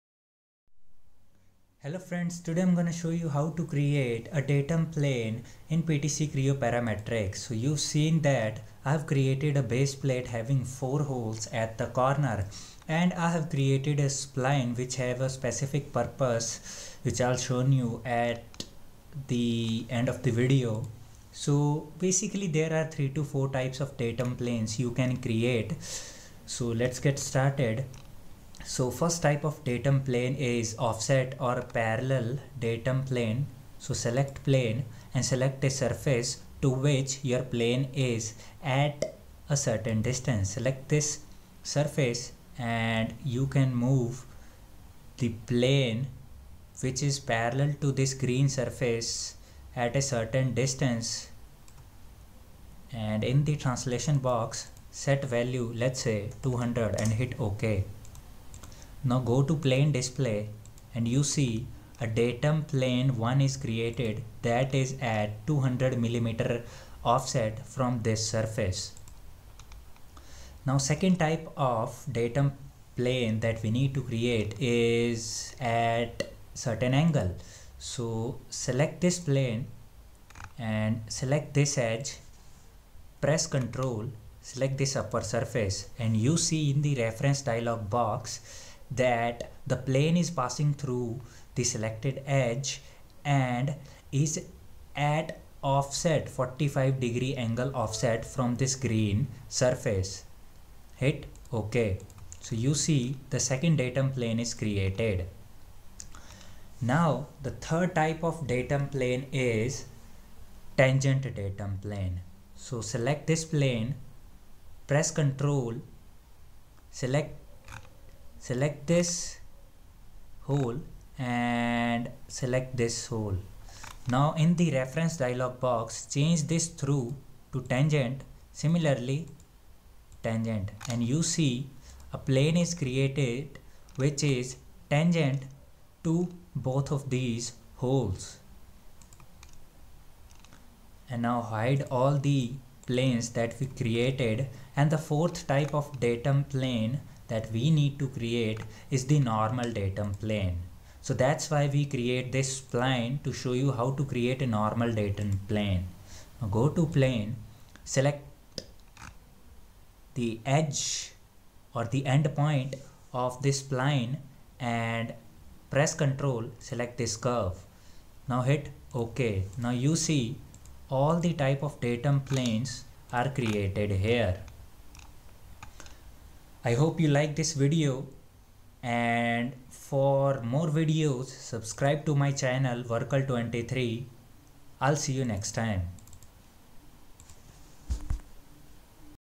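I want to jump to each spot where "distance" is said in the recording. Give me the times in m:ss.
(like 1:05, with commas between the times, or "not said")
0:40, 0:50.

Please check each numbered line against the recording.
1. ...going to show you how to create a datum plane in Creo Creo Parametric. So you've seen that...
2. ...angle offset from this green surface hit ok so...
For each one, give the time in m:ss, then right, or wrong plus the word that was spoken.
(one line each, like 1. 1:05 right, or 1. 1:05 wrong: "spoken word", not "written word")
1. 0:02 wrong: "PTC", not "Creo"
2. 1:37 right.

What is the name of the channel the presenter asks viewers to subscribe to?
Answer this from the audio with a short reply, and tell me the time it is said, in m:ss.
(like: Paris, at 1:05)
Workal23, at 3:02.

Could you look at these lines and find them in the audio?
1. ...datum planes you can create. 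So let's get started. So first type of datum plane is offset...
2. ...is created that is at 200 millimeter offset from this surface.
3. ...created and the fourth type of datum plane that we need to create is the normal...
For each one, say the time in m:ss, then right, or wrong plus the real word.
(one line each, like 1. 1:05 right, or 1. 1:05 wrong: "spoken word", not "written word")
1. 0:23 right
2. 1:03 right
3. 2:23 right.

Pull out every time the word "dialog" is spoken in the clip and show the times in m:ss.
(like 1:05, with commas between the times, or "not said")
1:27, 2:05.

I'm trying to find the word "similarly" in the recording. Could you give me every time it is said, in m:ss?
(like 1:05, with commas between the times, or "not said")
2:08.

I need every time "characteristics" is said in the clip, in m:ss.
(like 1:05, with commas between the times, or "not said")
not said.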